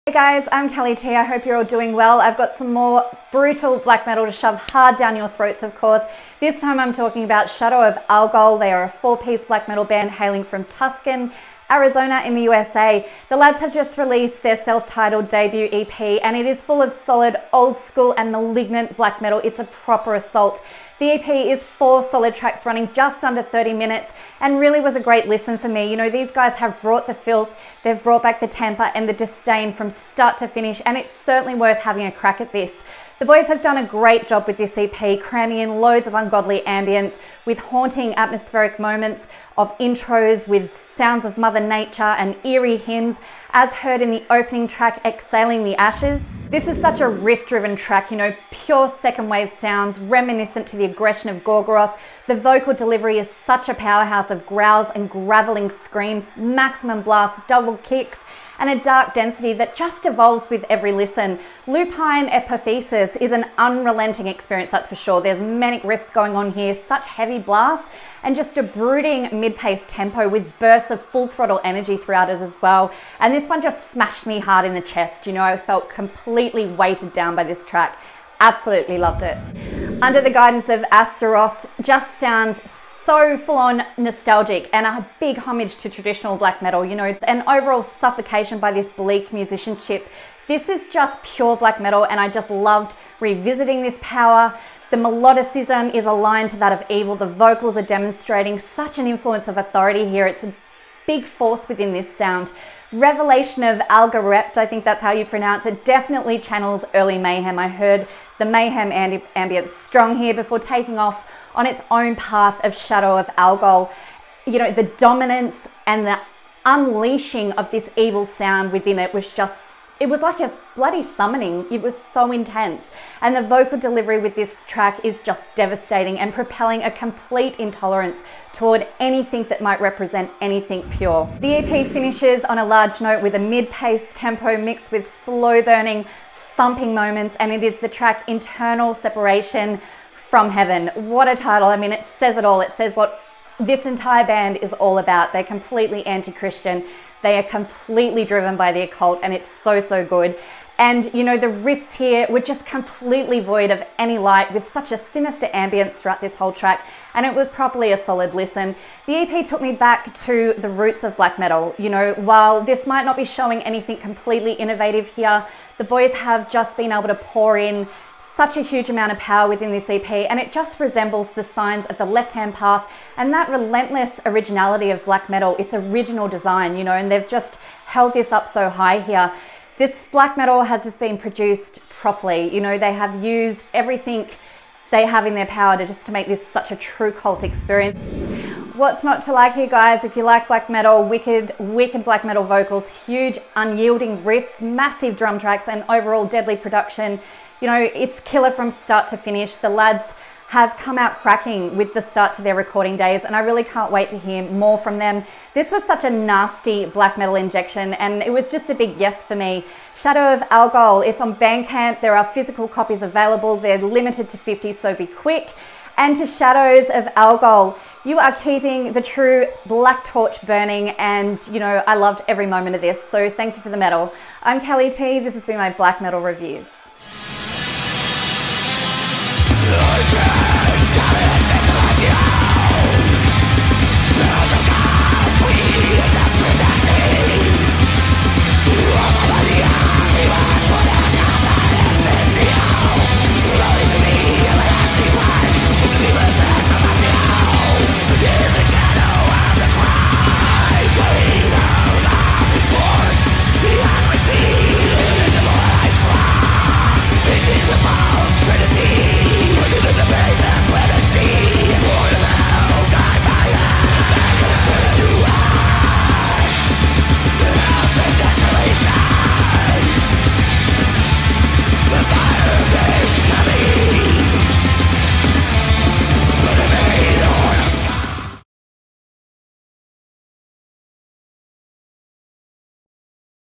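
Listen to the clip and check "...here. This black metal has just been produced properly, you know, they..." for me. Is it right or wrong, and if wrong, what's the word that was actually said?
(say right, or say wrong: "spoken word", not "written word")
right.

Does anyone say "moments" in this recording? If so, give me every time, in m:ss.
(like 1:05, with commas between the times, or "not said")
0:38, 2:16, 3:42.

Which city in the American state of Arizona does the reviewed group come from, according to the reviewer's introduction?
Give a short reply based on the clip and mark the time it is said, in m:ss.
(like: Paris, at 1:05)
Tucson, at 0:10.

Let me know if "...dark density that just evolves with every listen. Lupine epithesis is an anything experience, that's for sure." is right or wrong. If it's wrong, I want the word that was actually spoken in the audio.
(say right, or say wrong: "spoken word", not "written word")
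wrong: "unrelenting", not "anything".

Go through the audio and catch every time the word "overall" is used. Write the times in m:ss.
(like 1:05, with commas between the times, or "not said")
1:27, 3:15.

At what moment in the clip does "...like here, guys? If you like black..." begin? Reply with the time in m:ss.
3:09.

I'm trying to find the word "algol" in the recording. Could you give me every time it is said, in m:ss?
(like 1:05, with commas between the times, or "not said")
0:08, 1:53, 3:30, 3:37.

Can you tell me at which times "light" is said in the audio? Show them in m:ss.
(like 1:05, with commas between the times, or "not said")
2:34.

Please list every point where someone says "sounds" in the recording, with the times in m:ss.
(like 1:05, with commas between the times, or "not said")
0:40, 0:49, 1:22, 1:42, 1:58.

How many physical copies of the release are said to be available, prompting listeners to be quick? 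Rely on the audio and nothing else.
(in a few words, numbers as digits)
50.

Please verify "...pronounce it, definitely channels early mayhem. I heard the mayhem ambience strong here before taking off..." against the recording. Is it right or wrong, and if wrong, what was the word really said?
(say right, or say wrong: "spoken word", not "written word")
right.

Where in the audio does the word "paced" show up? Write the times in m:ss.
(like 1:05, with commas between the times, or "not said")
1:09, 2:13.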